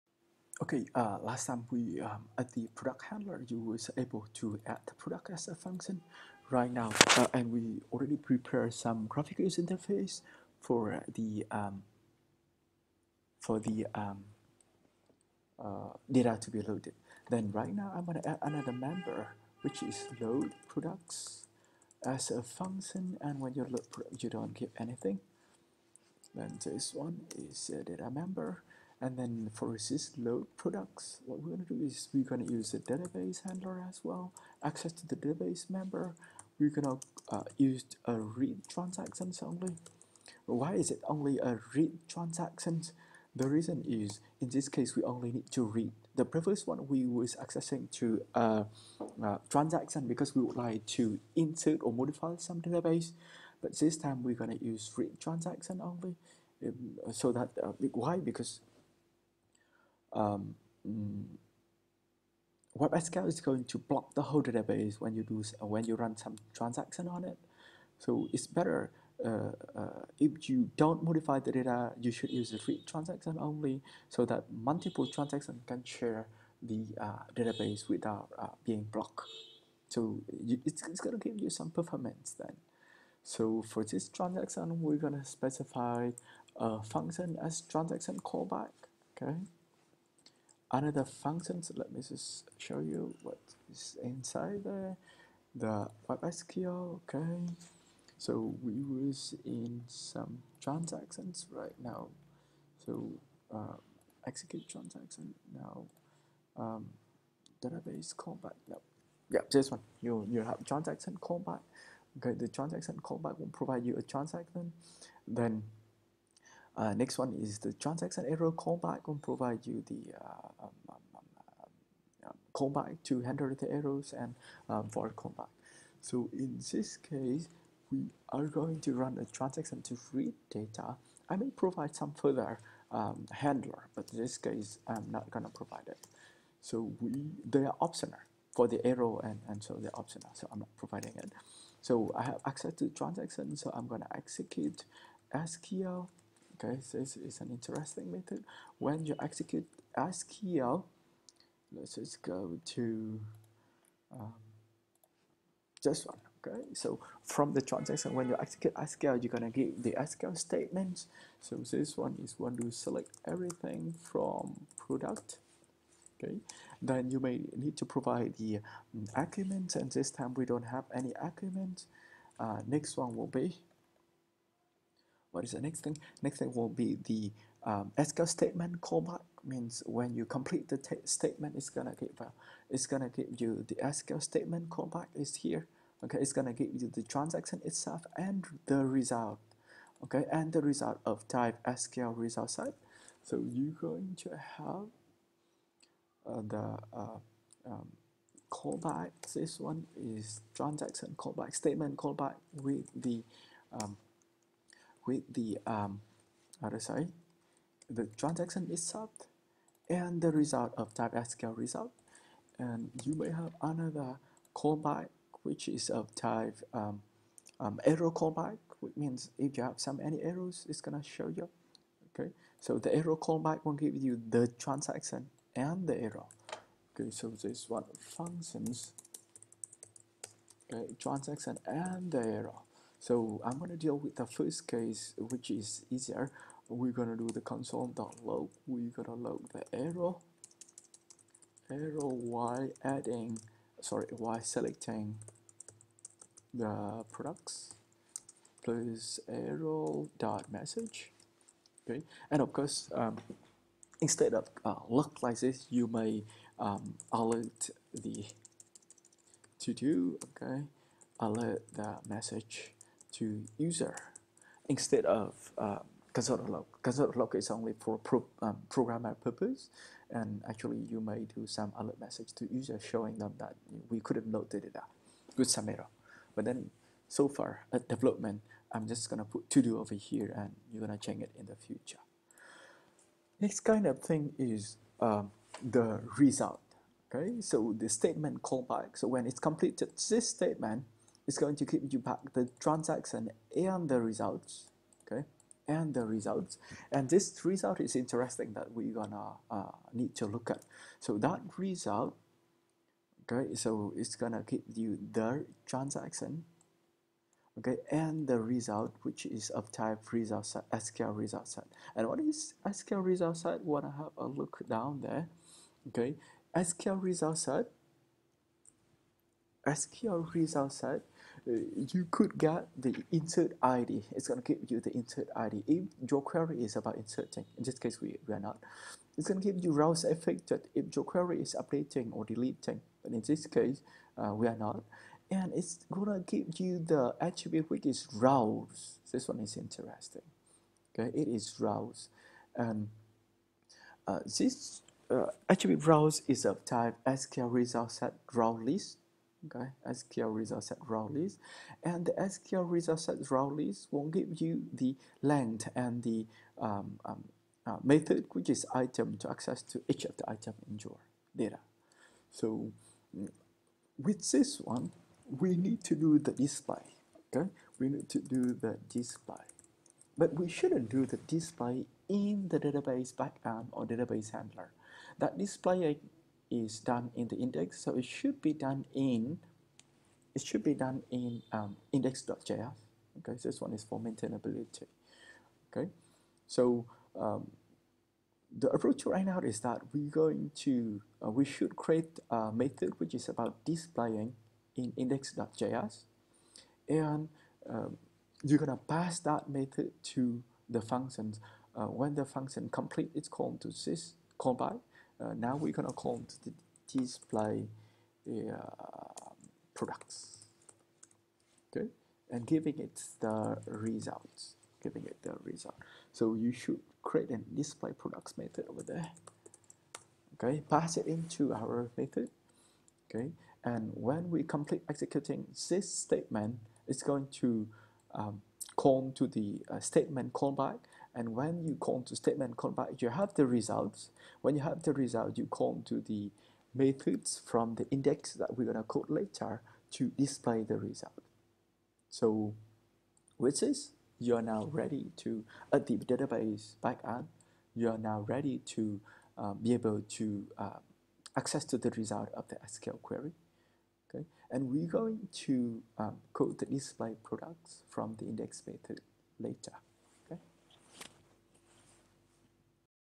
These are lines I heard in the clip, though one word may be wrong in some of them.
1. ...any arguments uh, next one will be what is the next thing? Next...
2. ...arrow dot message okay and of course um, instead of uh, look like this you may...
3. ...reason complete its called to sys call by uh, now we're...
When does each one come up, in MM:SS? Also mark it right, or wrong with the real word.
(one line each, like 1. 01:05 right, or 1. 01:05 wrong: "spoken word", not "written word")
1. 02:50 right
2. 04:09 right
3. 06:42 wrong: "function", not "reason".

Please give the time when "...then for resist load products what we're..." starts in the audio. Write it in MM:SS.
00:29.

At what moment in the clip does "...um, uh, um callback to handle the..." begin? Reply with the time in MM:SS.
02:01.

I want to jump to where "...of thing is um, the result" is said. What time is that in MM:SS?
04:43.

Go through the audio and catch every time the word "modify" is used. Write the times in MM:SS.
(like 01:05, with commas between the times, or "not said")
00:51, 01:11.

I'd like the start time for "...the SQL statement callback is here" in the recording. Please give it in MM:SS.
03:03.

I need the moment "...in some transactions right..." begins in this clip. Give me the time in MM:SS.
01:39.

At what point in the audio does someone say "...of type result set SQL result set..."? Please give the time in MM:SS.
05:09.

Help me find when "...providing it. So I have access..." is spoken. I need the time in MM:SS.
02:20.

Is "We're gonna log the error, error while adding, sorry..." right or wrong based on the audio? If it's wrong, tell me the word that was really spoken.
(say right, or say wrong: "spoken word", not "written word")
right.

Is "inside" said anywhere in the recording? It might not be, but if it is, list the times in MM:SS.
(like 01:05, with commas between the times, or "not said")
01:34.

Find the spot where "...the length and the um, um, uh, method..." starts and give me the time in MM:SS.
05:54.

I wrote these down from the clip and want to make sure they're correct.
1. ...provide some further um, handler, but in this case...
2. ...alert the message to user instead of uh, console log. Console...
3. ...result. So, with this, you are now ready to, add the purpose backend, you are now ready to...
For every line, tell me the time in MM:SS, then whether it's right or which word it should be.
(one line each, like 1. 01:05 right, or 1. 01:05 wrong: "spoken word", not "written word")
1. 02:11 right
2. 04:21 right
3. 07:20 wrong: "database", not "purpose".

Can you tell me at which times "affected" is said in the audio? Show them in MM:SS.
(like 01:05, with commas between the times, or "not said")
05:30.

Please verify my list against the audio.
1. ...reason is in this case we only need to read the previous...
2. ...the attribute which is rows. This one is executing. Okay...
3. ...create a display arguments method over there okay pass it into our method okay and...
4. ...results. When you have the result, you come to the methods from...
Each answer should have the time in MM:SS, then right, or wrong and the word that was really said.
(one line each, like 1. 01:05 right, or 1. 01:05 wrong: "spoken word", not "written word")
1. 00:43 right
2. 05:36 wrong: "interesting", not "executing"
3. 06:57 wrong: "products", not "arguments"
4. 07:13 right.